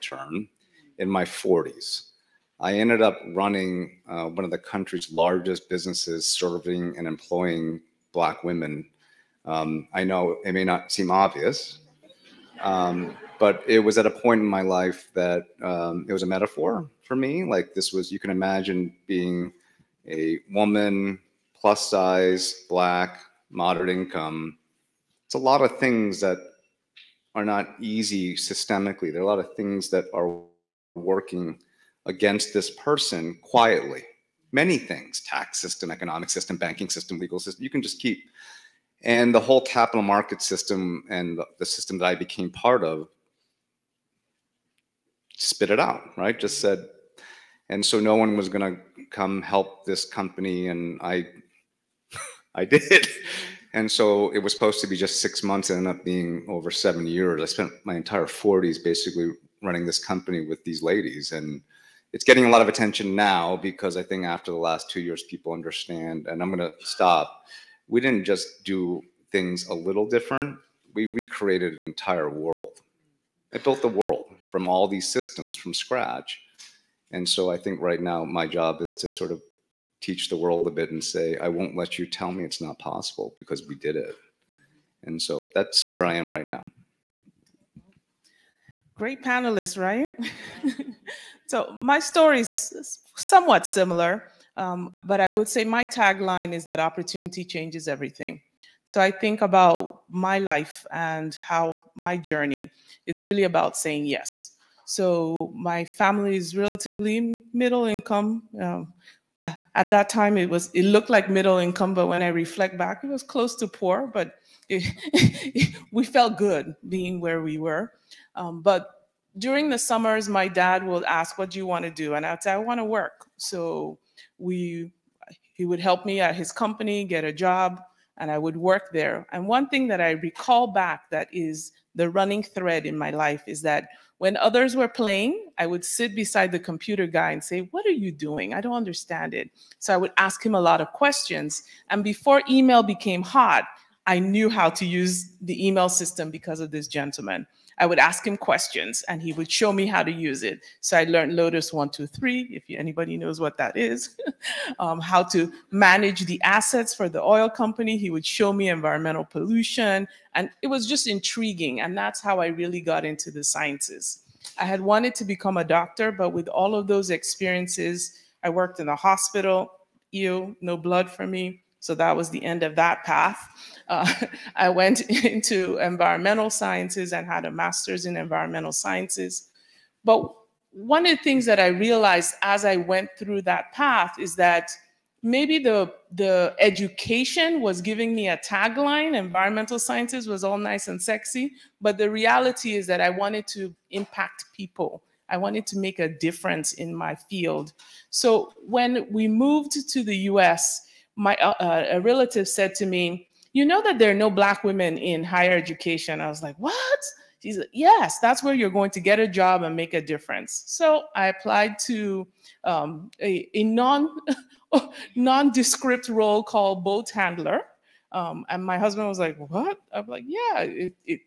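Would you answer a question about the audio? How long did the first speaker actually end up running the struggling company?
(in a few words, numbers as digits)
over 7 years.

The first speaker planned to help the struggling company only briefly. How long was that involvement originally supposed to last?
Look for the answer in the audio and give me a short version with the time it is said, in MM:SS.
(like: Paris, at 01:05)
6 months, at 00:55.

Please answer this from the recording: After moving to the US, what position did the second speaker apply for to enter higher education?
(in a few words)
boat handler.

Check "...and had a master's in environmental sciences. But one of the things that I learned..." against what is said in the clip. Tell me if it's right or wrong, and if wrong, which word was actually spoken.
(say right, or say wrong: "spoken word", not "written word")
wrong: "realized", not "learned".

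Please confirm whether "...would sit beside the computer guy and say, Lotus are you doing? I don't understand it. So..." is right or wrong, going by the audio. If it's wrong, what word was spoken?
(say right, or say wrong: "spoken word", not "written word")
wrong: "What", not "Lotus".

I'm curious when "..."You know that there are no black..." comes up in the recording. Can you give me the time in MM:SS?
03:23.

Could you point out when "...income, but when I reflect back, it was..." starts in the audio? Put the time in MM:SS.
01:51.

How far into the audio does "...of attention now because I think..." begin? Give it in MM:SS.
01:02.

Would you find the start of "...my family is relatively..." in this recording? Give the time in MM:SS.
01:45.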